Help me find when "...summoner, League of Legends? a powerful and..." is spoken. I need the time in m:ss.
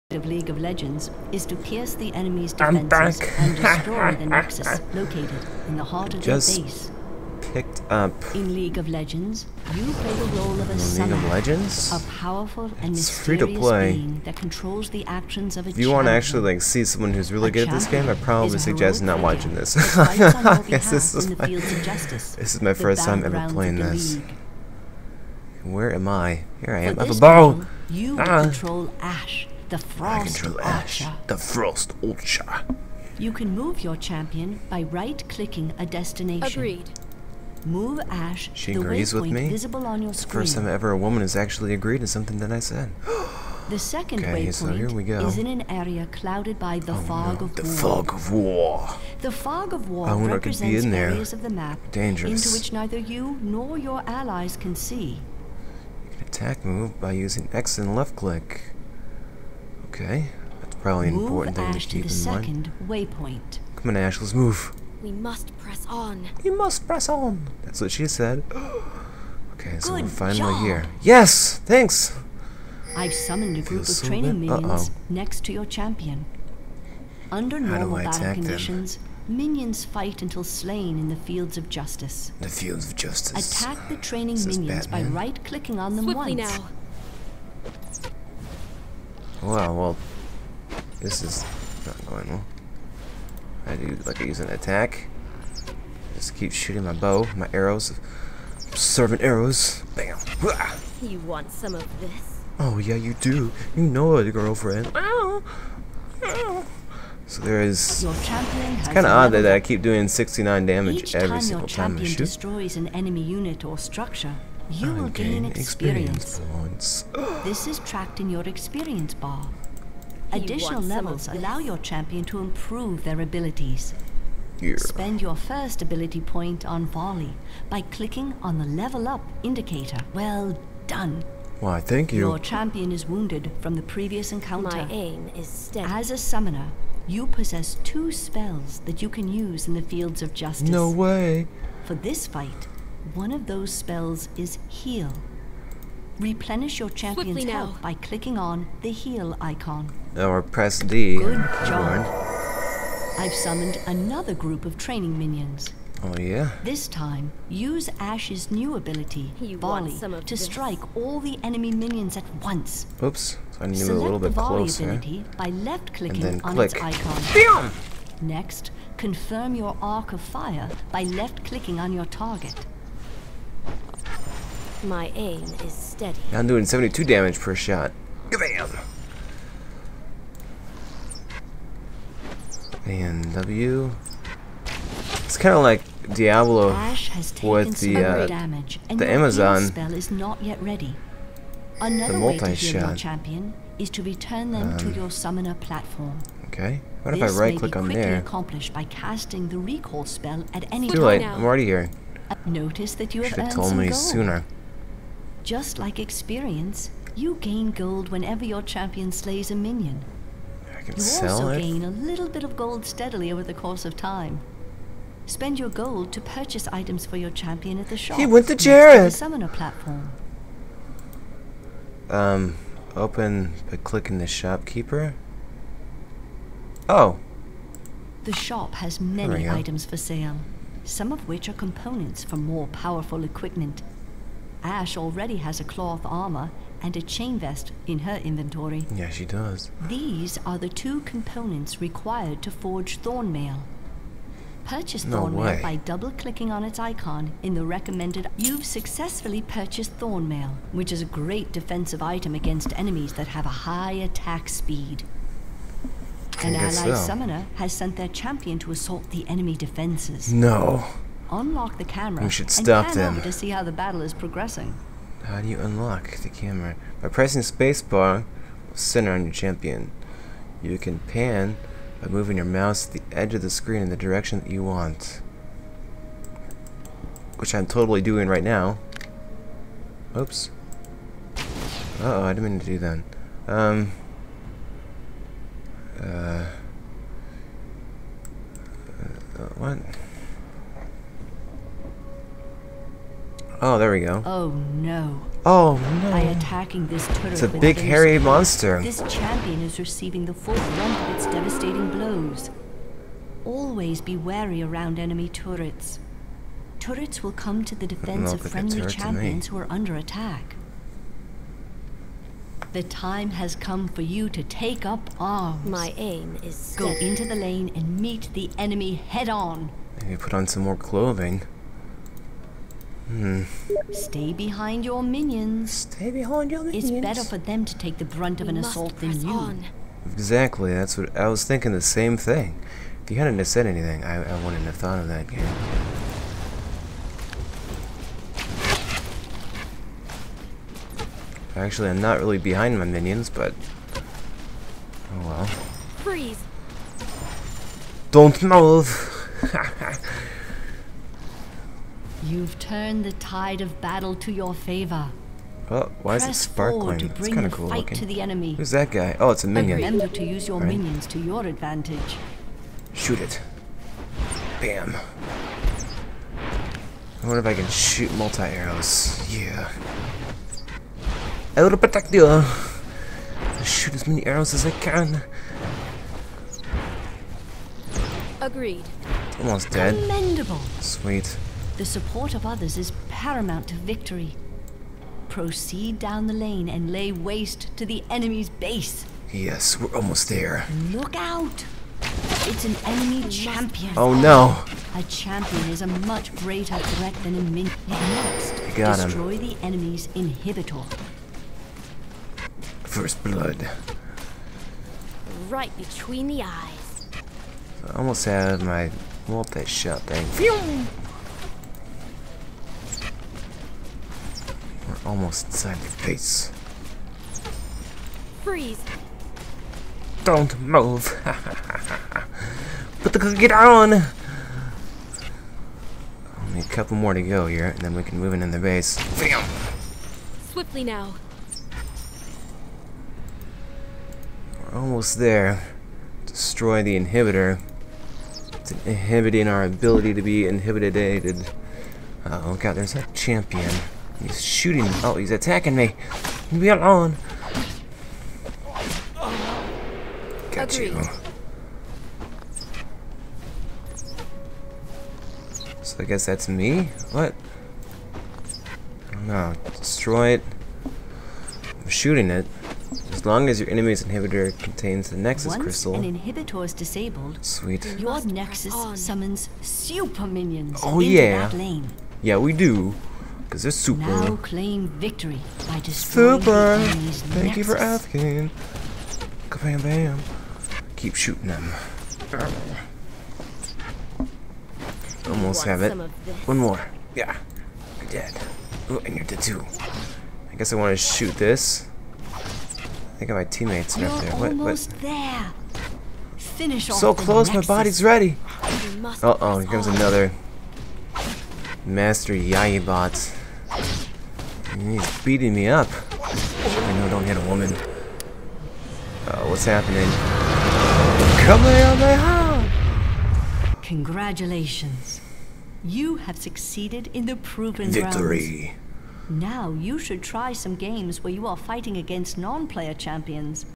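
0:10.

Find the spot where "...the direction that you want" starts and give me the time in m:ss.
4:33.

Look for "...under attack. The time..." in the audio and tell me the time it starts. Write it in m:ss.
5:09.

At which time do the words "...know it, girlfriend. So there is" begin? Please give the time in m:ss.
1:43.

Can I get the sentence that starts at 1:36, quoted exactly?
Just keep shooting my bow, my arrows, servant arrows.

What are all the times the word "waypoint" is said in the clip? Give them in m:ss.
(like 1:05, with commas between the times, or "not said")
0:44, 1:02.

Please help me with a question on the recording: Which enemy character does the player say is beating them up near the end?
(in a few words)
Master Yi.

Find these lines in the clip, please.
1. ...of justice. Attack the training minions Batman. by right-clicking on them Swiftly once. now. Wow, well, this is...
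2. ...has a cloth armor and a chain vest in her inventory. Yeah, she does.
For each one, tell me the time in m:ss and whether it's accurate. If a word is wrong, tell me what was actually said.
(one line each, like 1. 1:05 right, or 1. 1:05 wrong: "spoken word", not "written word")
1. 1:22 right
2. 3:55 right.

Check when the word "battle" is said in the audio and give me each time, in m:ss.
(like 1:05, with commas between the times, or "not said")
1:18, 4:23, 5:53.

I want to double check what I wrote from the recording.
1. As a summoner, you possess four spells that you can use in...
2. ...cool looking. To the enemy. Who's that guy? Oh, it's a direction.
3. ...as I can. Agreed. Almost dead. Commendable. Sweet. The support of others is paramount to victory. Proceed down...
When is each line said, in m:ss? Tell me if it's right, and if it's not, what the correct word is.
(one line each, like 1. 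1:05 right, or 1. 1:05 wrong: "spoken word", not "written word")
1. 2:15 wrong: "two", not "four"
2. 5:57 wrong: "minion", not "direction"
3. 6:14 right.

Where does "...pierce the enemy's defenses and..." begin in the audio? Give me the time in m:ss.
0:01.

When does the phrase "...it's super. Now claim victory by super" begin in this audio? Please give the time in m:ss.
7:53.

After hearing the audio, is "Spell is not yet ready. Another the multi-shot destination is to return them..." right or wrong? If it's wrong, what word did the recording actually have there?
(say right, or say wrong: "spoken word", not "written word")
wrong: "champion", not "destination".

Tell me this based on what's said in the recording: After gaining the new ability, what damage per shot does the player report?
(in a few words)
72.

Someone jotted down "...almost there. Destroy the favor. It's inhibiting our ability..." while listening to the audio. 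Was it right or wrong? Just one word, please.
wrong.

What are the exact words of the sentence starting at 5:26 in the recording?
It's better for them to take the brunt of an assault than you.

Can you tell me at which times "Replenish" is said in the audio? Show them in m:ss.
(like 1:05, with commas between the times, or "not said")
2:26.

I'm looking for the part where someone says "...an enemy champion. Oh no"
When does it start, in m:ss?
6:32.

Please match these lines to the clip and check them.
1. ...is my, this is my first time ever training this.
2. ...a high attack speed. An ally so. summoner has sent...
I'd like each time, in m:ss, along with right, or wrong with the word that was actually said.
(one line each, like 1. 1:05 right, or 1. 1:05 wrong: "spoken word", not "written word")
1. 0:21 wrong: "playing", not "training"
2. 4:13 right.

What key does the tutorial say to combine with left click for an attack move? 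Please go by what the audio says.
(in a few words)
X.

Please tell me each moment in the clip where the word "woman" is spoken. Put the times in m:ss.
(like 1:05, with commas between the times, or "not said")
0:40, 8:27.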